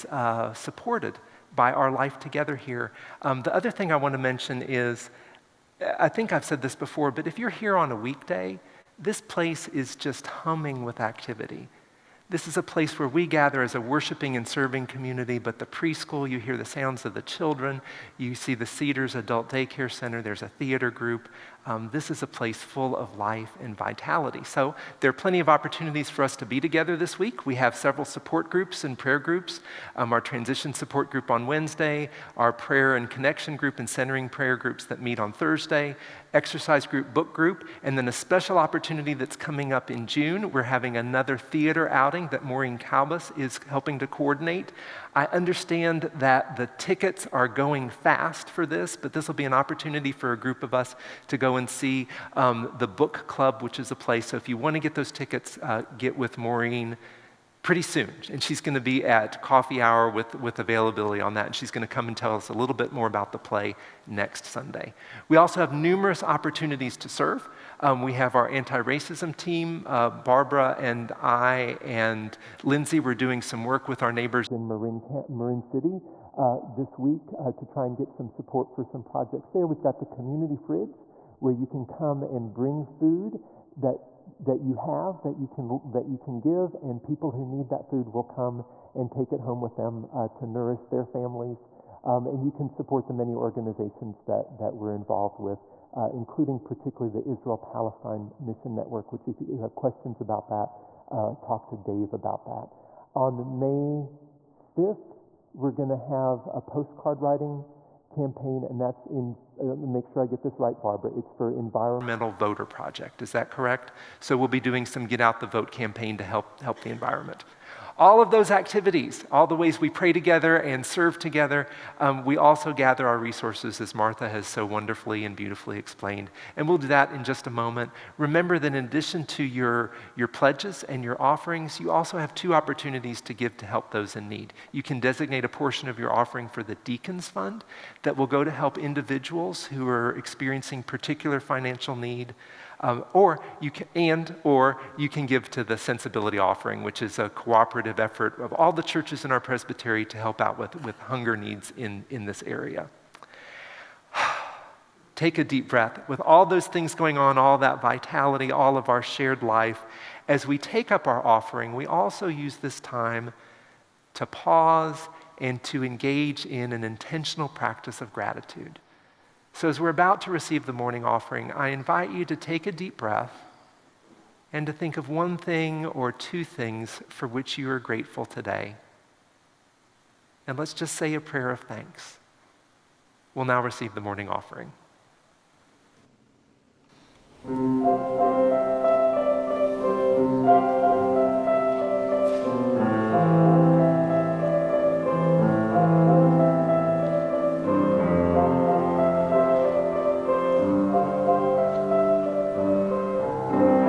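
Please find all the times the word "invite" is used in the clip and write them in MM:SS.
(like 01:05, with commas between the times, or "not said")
02:51.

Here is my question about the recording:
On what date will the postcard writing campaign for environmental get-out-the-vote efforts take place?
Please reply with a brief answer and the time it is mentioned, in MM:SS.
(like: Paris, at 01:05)
May 5, at 01:43.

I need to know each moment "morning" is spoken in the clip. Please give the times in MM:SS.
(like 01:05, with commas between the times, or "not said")
02:50, 03:03.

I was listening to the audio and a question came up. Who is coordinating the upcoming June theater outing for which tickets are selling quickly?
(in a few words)
Maureen Calbus.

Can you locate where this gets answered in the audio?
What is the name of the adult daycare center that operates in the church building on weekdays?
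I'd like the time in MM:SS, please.
00:18.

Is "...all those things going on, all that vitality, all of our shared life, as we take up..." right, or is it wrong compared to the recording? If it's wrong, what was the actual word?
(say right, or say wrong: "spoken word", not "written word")
right.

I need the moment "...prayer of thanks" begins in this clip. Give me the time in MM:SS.
03:01.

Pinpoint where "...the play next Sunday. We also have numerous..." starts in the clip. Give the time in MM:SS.
01:03.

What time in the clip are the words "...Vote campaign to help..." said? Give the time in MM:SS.
01:55.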